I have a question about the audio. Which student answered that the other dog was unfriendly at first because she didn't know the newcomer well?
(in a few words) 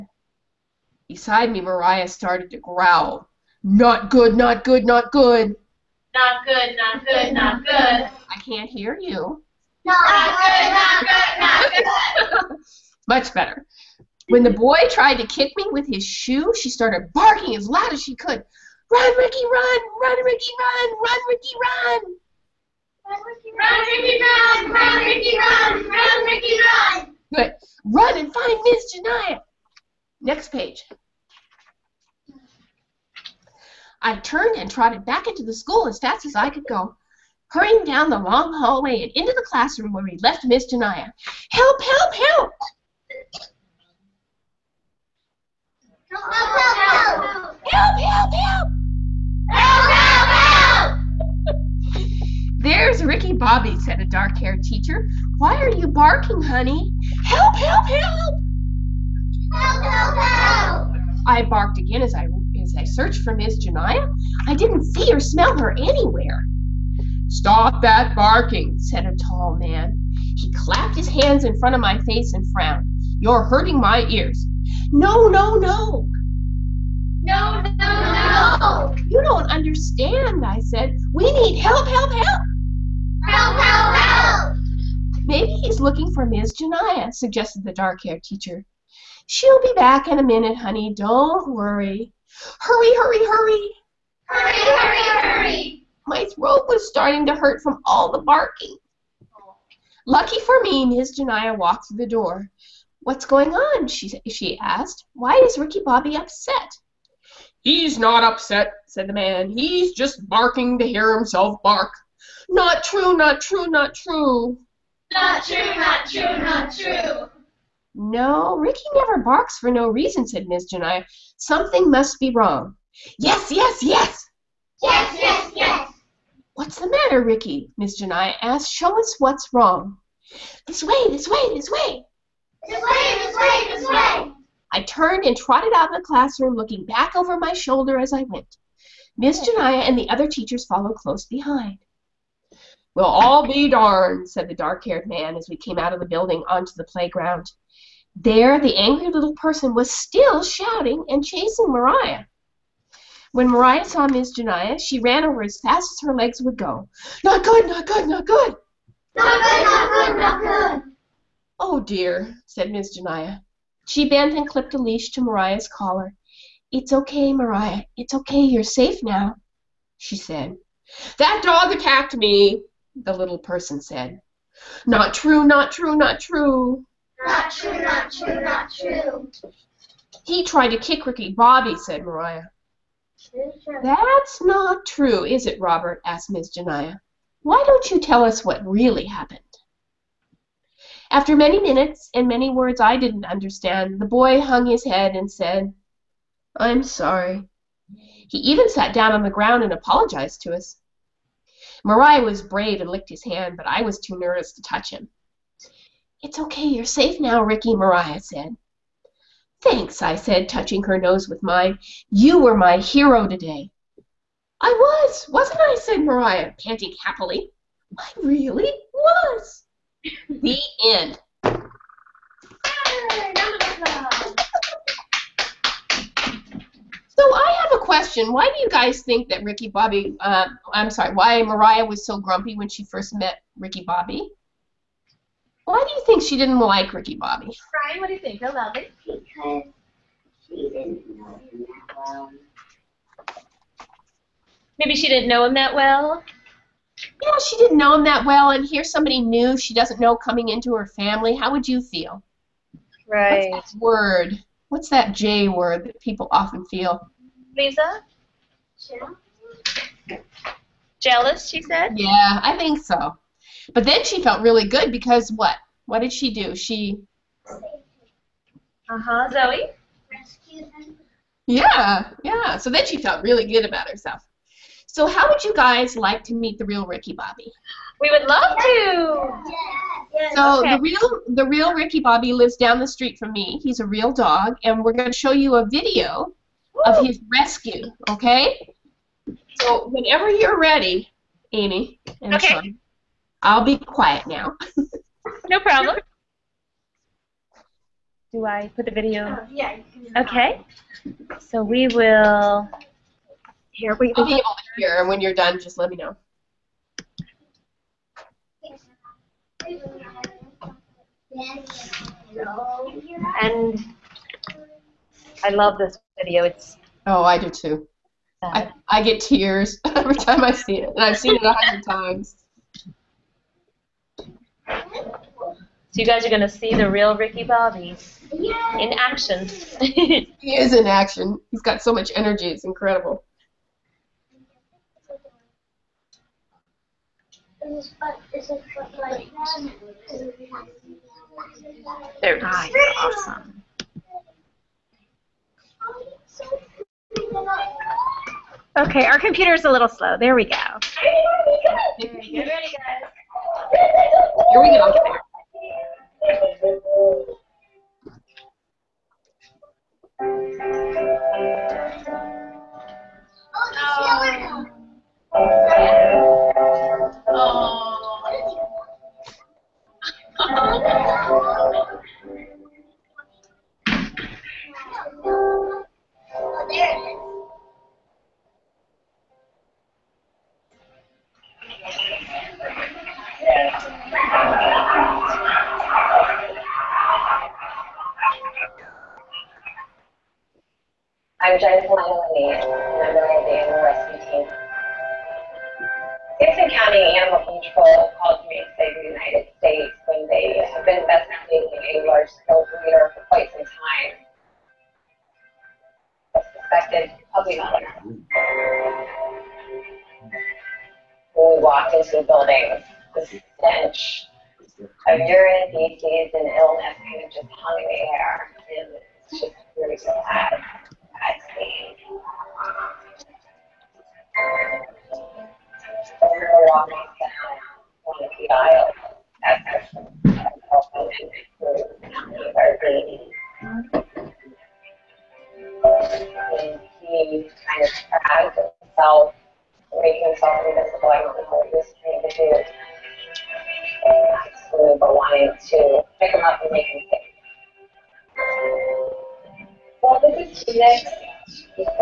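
Brian.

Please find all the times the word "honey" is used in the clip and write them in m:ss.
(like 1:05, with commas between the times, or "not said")
0:56, 1:30.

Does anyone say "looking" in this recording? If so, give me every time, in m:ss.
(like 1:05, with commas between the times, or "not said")
1:25, 2:16.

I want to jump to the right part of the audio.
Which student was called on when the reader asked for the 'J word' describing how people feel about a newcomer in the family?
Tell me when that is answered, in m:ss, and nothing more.
4:17.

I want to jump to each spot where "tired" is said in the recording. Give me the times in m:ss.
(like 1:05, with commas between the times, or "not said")
not said.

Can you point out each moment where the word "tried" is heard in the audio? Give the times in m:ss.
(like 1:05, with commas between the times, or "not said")
0:14, 3:00.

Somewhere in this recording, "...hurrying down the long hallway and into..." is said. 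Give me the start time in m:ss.
0:37.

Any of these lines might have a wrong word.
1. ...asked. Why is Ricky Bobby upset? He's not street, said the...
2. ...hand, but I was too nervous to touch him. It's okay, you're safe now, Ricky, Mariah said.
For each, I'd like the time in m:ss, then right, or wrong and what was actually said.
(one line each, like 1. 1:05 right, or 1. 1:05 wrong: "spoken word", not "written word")
1. 1:44 wrong: "upset", not "street"
2. 3:23 right.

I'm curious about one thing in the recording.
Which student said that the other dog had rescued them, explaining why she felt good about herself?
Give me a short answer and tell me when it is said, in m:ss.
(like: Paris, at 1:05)
Zoe, at 4:29.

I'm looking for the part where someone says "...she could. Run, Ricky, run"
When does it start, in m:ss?
0:18.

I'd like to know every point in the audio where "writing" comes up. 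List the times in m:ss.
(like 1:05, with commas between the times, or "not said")
not said.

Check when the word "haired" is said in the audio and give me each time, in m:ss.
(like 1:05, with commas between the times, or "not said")
0:54, 1:27, 2:24.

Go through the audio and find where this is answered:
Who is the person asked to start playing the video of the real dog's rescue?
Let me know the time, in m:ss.
4:51.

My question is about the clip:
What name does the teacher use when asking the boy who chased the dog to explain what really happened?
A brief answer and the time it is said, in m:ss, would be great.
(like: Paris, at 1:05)
Robert, at 3:05.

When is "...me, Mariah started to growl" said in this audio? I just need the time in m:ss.
0:01.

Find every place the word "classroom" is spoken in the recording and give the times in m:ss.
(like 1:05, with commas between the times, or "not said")
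0:39, 2:16.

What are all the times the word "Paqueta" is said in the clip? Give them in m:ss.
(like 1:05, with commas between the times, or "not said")
not said.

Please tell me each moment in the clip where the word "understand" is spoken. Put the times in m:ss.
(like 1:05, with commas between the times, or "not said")
1:19, 3:13.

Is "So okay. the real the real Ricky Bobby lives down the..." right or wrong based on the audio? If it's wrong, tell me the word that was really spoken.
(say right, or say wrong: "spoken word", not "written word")
right.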